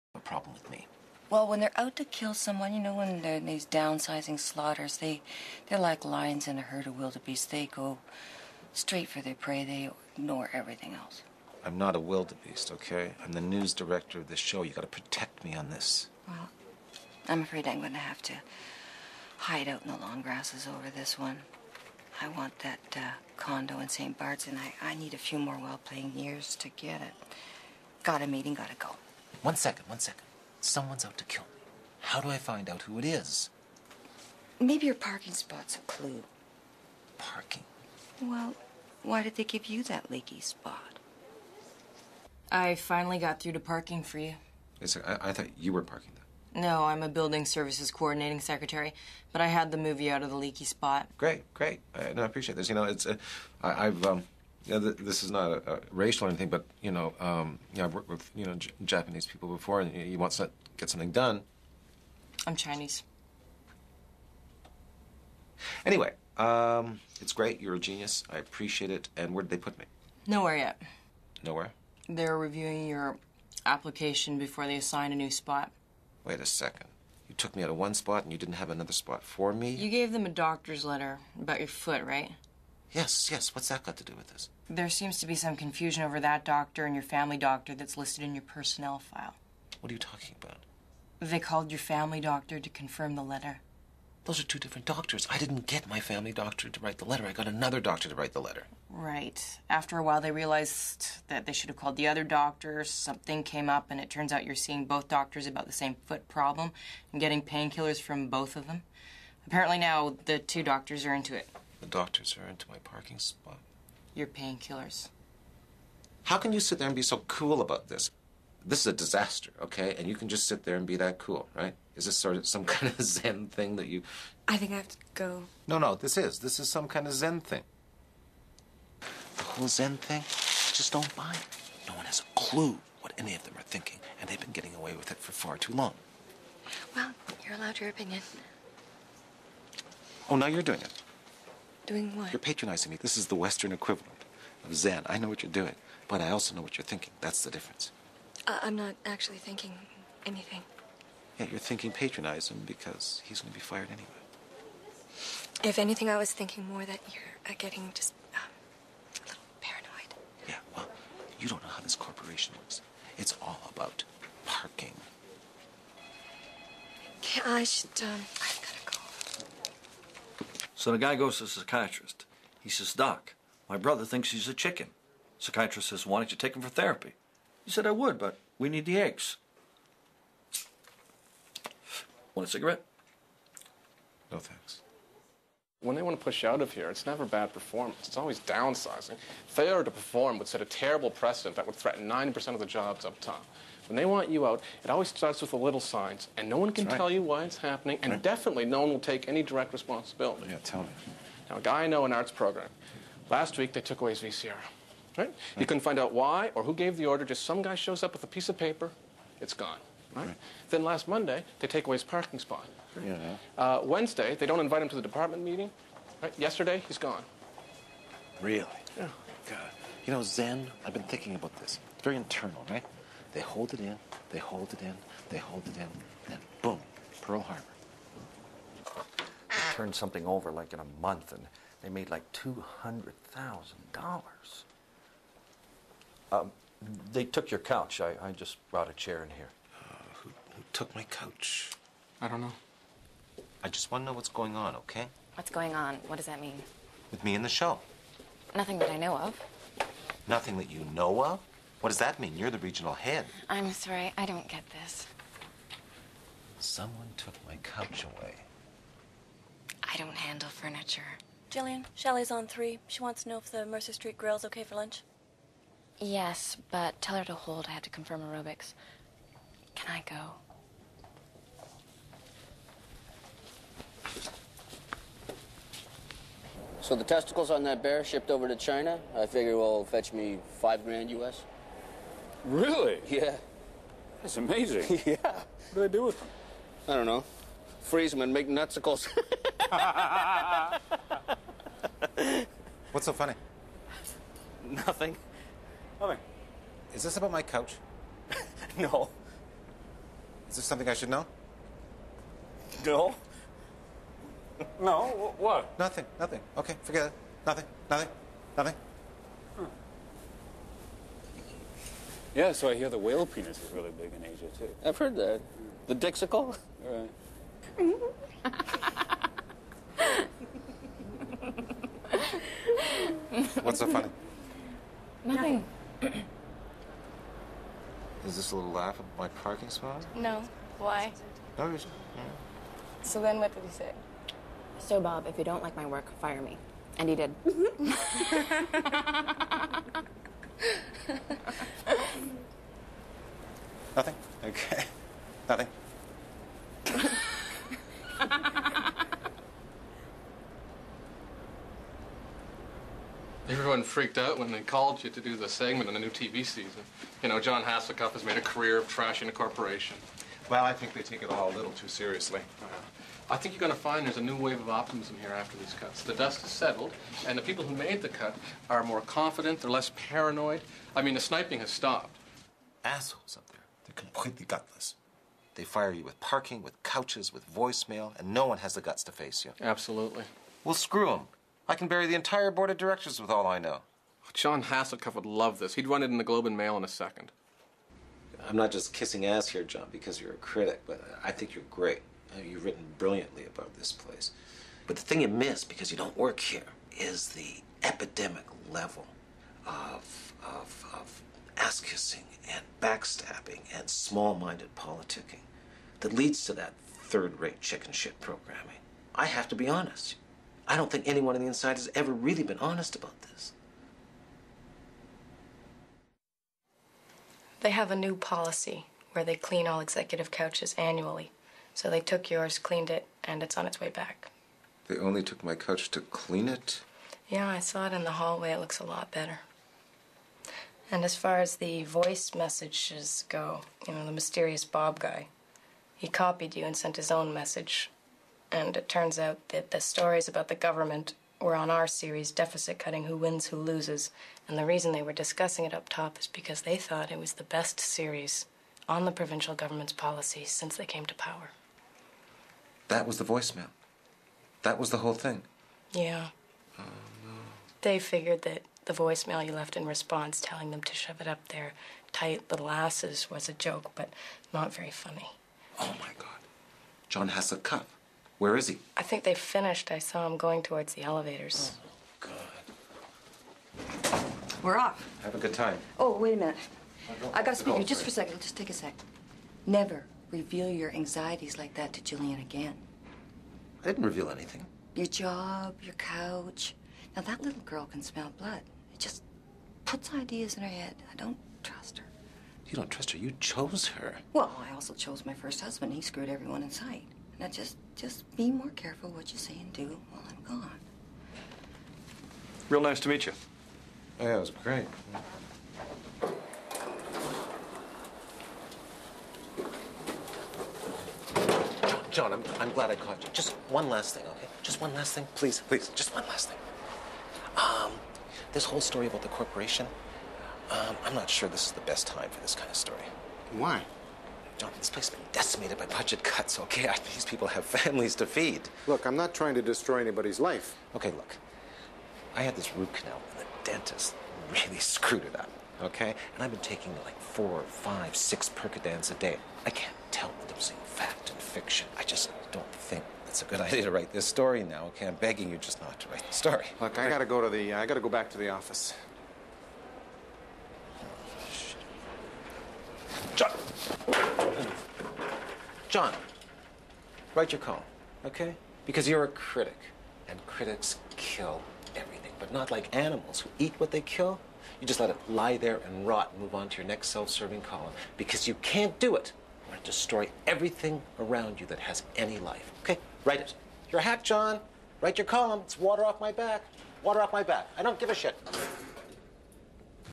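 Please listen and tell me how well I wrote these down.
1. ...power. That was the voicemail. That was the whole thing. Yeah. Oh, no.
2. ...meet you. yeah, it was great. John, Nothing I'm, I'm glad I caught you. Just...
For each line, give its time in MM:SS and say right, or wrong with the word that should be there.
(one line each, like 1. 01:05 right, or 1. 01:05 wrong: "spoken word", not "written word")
1. 07:31 right
2. 08:23 wrong: "John", not "Nothing".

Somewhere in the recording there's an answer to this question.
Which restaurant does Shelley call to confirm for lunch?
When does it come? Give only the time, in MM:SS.
04:23.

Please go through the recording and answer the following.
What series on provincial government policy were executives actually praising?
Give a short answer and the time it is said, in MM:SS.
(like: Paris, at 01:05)
Deficit Cutting Who Wins, Who Loses, at 07:22.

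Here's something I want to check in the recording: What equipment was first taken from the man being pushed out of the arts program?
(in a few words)
VCR.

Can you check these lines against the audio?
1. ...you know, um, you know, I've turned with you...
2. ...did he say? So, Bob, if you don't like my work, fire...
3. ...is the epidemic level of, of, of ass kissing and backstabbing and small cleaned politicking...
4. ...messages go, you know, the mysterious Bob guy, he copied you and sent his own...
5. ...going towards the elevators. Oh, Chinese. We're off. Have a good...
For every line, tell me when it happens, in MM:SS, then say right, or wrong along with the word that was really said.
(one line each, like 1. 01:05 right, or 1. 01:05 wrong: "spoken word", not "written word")
1. 00:56 wrong: "worked", not "turned"
2. 05:33 right
3. 06:36 wrong: "minded", not "cleaned"
4. 07:12 right
5. 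07:50 wrong: "God", not "Chinese".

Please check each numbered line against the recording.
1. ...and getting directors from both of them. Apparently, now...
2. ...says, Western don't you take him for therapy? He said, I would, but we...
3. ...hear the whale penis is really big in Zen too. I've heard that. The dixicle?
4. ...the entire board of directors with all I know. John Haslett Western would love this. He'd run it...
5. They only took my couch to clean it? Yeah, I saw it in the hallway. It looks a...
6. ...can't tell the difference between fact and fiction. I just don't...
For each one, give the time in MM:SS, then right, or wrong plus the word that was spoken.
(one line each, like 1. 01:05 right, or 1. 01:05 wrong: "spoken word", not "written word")
1. 01:47 wrong: "painkillers", not "directors"
2. 02:55 wrong: "Why", not "Western"
3. 05:12 wrong: "Asia", not "Zen"
4. 06:22 wrong: "Cuff", not "Western"
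5. 07:04 right
6. 08:59 right.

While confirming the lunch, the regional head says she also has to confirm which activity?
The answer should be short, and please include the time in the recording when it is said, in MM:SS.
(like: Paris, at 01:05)
aerobics, at 04:28.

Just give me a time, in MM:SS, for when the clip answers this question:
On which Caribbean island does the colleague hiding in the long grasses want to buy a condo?
00:23.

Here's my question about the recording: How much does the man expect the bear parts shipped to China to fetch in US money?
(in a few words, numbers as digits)
5 grand.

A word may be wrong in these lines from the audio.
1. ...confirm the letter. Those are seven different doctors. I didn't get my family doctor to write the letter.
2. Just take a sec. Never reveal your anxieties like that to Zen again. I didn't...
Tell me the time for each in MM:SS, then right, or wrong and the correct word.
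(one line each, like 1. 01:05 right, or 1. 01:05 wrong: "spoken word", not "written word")
1. 01:32 wrong: "two", not "seven"
2. 07:58 wrong: "Julian", not "Zen".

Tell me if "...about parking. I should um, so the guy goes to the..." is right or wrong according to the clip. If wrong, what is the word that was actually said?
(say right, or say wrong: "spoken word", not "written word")
right.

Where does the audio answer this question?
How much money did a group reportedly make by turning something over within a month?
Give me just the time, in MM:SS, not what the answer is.
03:52.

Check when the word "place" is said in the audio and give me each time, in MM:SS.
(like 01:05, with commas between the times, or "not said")
06:33, 08:44.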